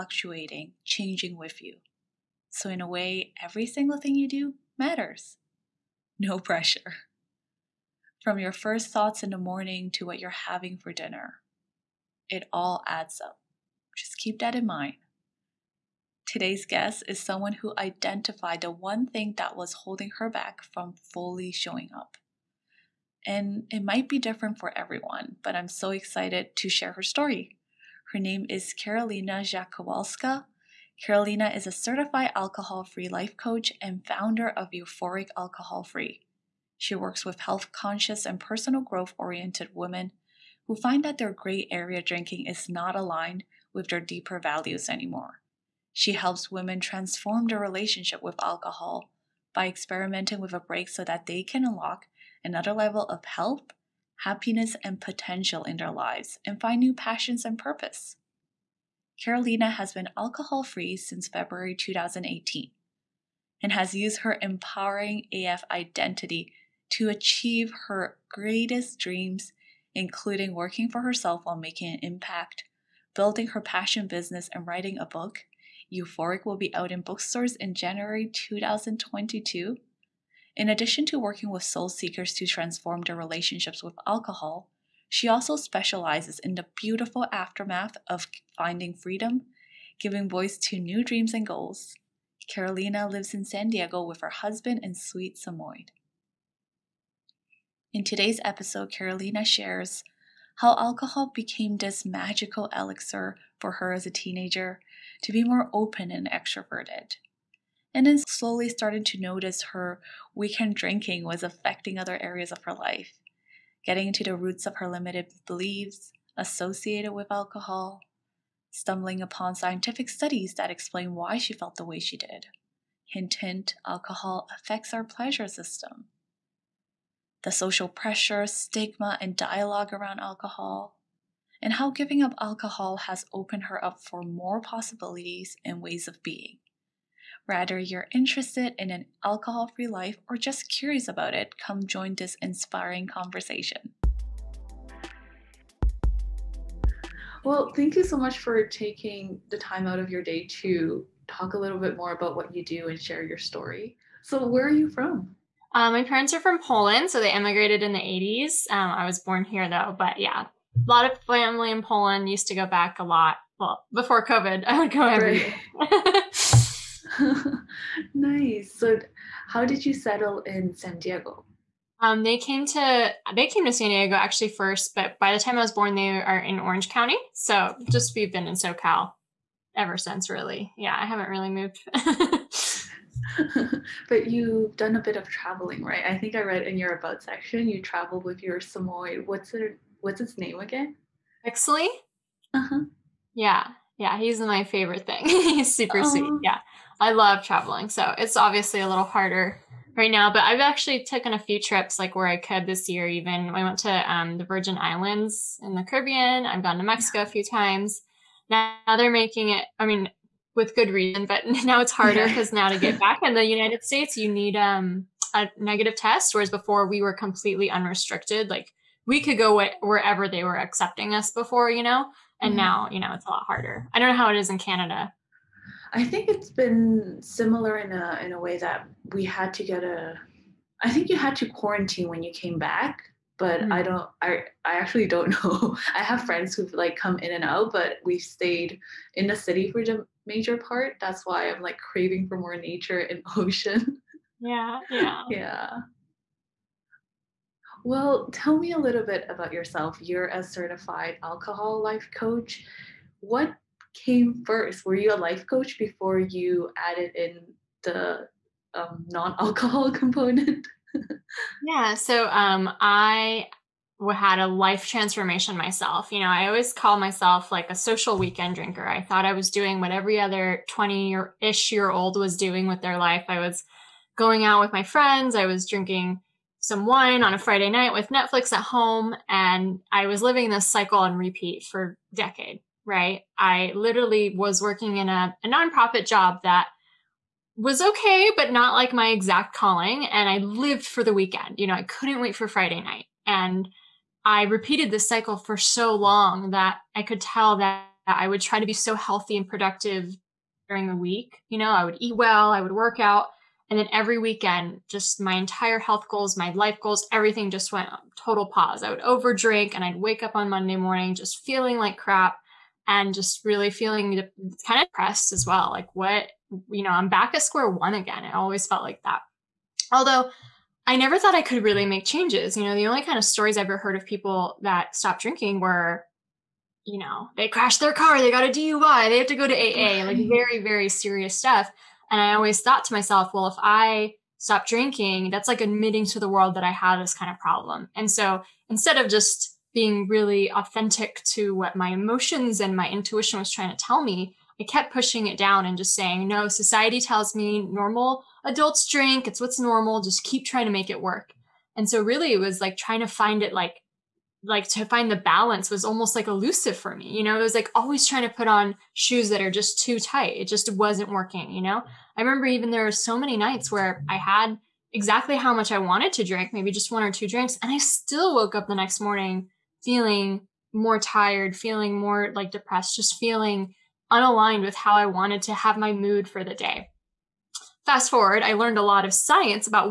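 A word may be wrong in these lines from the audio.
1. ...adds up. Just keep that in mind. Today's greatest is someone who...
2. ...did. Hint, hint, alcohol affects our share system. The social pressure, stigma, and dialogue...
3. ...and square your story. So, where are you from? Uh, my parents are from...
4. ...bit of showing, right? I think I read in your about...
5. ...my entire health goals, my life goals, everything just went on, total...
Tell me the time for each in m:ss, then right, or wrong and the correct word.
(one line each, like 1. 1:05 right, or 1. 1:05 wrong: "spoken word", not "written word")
1. 0:12 wrong: "guest", not "greatest"
2. 2:02 wrong: "pleasure", not "share"
3. 2:32 wrong: "share", not "square"
4. 3:05 wrong: "traveling", not "showing"
5. 5:05 right.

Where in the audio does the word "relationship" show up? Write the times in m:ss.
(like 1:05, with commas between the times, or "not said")
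0:47, 1:23.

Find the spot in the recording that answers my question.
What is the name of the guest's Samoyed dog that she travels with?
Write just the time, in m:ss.
3:11.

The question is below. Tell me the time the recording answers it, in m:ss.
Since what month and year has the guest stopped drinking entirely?
1:01.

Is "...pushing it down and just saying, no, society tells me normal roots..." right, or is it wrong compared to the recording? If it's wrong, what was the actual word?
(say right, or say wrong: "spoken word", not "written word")
wrong: "adults", not "roots".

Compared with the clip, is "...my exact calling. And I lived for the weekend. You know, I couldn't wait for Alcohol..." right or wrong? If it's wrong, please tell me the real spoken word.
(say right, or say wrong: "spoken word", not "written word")
wrong: "Friday", not "Alcohol".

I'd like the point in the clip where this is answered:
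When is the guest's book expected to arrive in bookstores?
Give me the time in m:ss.
1:17.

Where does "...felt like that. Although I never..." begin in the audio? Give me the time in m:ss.
5:18.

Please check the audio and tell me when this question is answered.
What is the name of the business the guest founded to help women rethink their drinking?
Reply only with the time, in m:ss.
0:34.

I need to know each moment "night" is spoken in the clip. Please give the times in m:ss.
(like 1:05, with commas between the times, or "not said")
4:37, 4:52, 6:03.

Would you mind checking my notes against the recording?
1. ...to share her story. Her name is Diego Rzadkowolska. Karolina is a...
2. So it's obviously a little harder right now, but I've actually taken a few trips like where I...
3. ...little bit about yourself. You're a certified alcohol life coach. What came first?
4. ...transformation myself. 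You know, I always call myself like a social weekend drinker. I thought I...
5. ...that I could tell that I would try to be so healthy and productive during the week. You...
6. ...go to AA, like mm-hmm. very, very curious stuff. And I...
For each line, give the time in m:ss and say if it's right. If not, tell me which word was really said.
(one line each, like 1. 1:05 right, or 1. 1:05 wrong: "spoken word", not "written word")
1. 0:26 wrong: "Karolina", not "Diego"
2. 3:17 right
3. 4:08 right
4. 4:24 right
5. 4:56 right
6. 5:29 wrong: "serious", not "curious".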